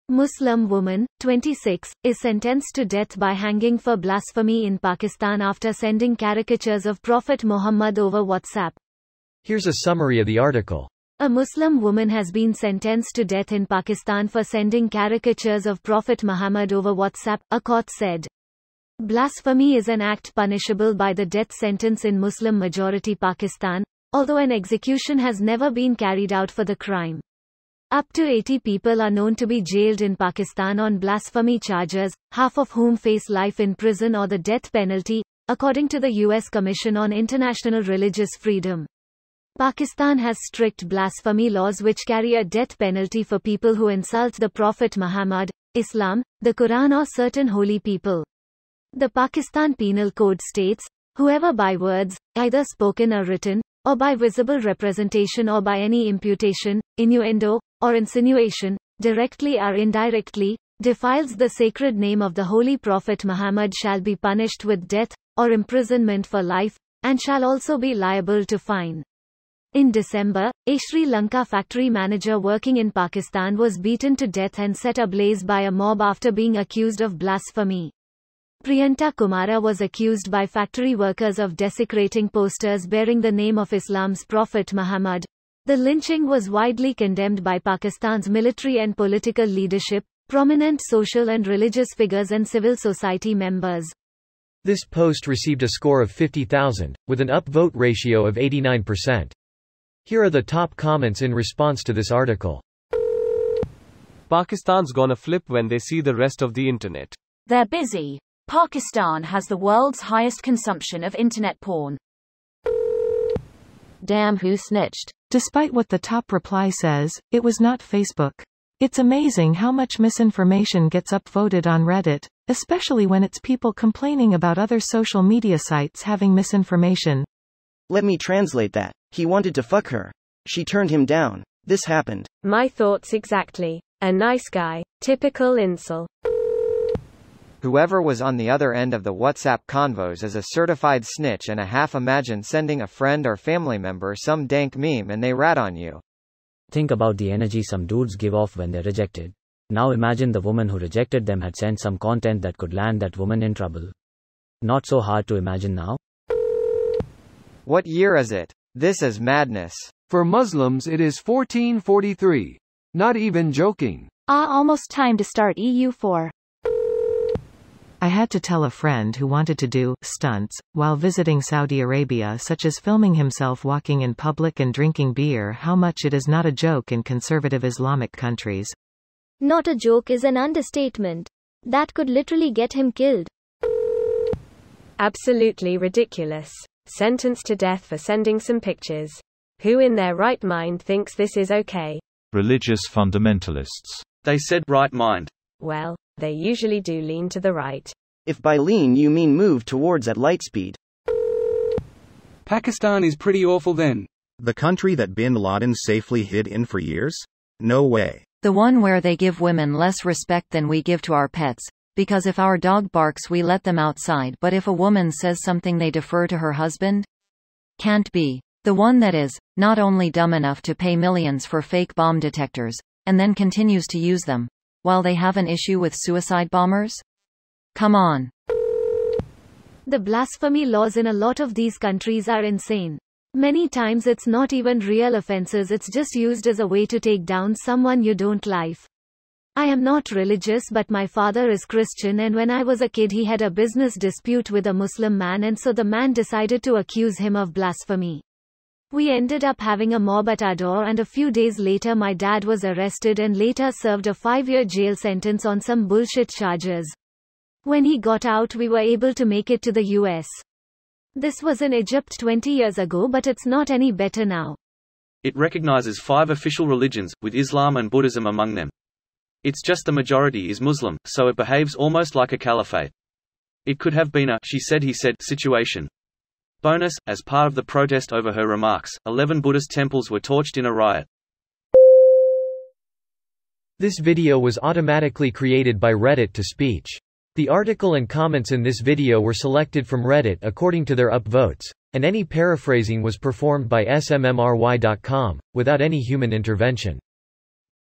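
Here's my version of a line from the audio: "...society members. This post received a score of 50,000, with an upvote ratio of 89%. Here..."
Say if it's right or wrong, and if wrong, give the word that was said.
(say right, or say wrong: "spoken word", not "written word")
right.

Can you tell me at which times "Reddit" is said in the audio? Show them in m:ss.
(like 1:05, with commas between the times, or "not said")
2:01, 4:45, 4:50.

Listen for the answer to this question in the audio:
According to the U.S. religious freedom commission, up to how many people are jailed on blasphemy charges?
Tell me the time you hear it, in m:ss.
0:28.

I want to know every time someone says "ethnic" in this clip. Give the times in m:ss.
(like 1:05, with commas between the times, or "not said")
not said.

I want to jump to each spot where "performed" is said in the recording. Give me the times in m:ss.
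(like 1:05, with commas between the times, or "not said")
4:53.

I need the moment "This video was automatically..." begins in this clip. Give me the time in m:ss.
4:43.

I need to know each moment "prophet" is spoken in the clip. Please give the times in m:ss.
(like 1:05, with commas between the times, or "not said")
0:07, 0:15, 0:44, 1:02, 1:24.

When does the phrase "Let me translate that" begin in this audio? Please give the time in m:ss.
2:07.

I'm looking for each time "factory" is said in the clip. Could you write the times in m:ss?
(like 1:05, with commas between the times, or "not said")
1:11, 1:20.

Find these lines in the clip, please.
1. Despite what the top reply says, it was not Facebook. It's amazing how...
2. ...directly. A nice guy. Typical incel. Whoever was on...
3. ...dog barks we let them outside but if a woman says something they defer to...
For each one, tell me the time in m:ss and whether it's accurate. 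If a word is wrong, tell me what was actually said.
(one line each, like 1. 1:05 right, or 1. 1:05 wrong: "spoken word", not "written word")
1. 1:55 right
2. 2:13 wrong: "exactly", not "directly"
3. 3:32 right.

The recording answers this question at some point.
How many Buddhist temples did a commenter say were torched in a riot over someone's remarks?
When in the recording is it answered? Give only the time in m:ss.
4:39.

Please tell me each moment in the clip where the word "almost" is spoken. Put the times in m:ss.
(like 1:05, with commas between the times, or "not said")
2:44, 4:31.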